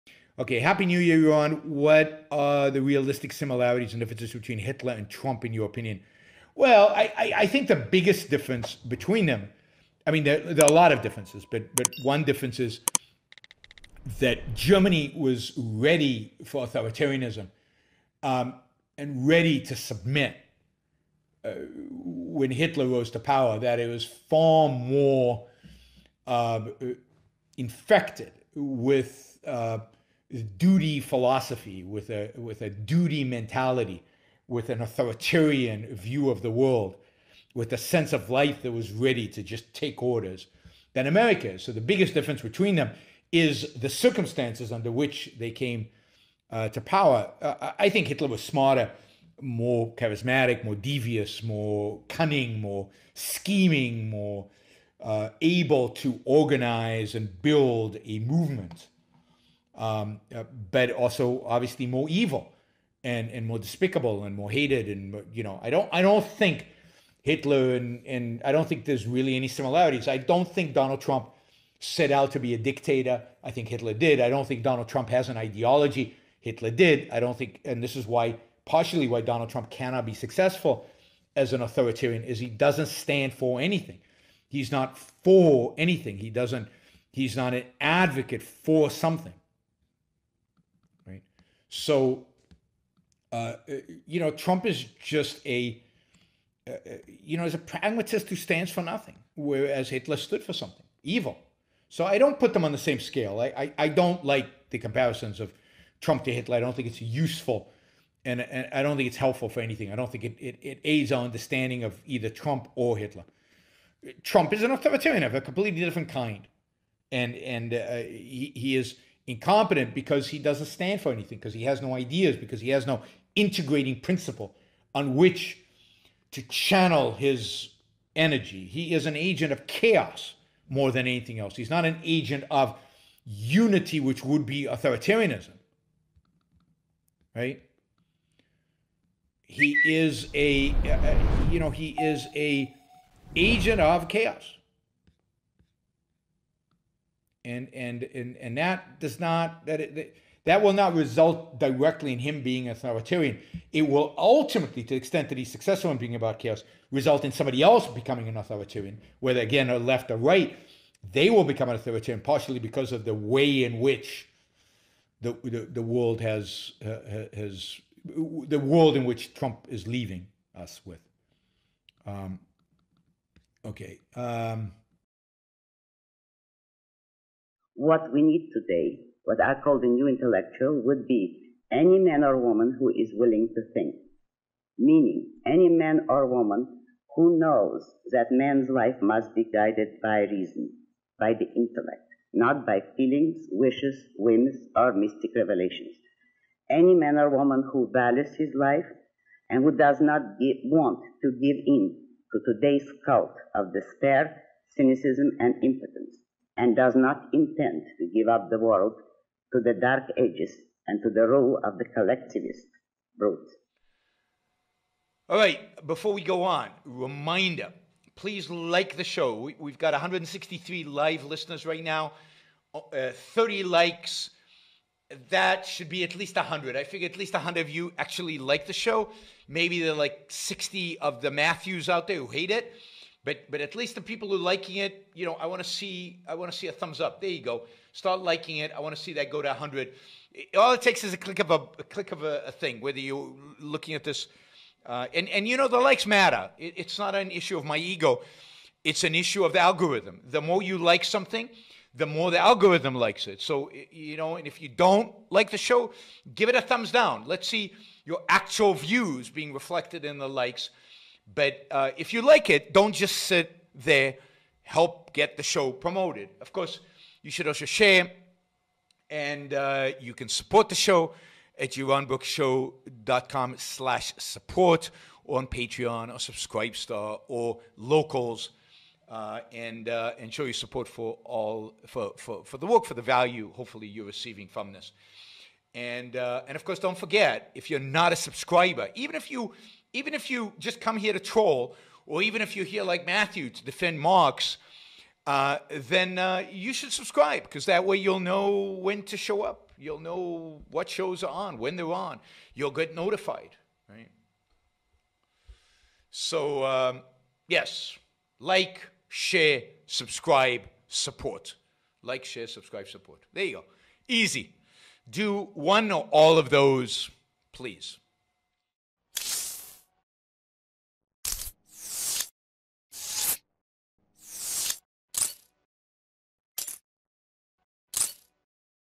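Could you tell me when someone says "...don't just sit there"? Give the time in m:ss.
4:22.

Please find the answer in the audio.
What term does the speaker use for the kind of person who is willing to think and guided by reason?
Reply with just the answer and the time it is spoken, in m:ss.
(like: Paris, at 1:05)
the new intellectual, at 2:59.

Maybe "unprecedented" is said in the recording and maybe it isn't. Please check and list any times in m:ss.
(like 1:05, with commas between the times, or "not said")
not said.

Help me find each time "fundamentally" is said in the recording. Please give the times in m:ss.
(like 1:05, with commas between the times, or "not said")
not said.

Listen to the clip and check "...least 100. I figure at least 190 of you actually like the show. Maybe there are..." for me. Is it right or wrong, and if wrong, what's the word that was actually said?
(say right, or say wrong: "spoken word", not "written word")
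wrong: "100", not "190".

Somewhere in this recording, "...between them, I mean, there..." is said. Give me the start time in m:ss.
0:08.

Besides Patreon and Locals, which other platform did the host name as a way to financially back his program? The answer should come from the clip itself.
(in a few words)
Subscribestar.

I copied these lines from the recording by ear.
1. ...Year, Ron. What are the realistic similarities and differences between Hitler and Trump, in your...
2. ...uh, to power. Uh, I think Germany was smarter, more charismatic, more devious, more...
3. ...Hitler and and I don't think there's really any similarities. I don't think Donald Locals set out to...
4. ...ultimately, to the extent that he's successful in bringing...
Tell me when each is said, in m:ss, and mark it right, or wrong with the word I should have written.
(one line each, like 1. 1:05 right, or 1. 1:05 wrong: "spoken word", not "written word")
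1. 0:00 right
2. 0:46 wrong: "Hitler", not "Germany"
3. 1:07 wrong: "Trump", not "Locals"
4. 2:34 right.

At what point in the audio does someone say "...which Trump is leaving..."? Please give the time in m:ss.
2:49.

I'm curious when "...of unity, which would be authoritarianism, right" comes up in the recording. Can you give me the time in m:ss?
2:12.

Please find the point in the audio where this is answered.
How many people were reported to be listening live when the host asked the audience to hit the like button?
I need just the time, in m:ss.
3:39.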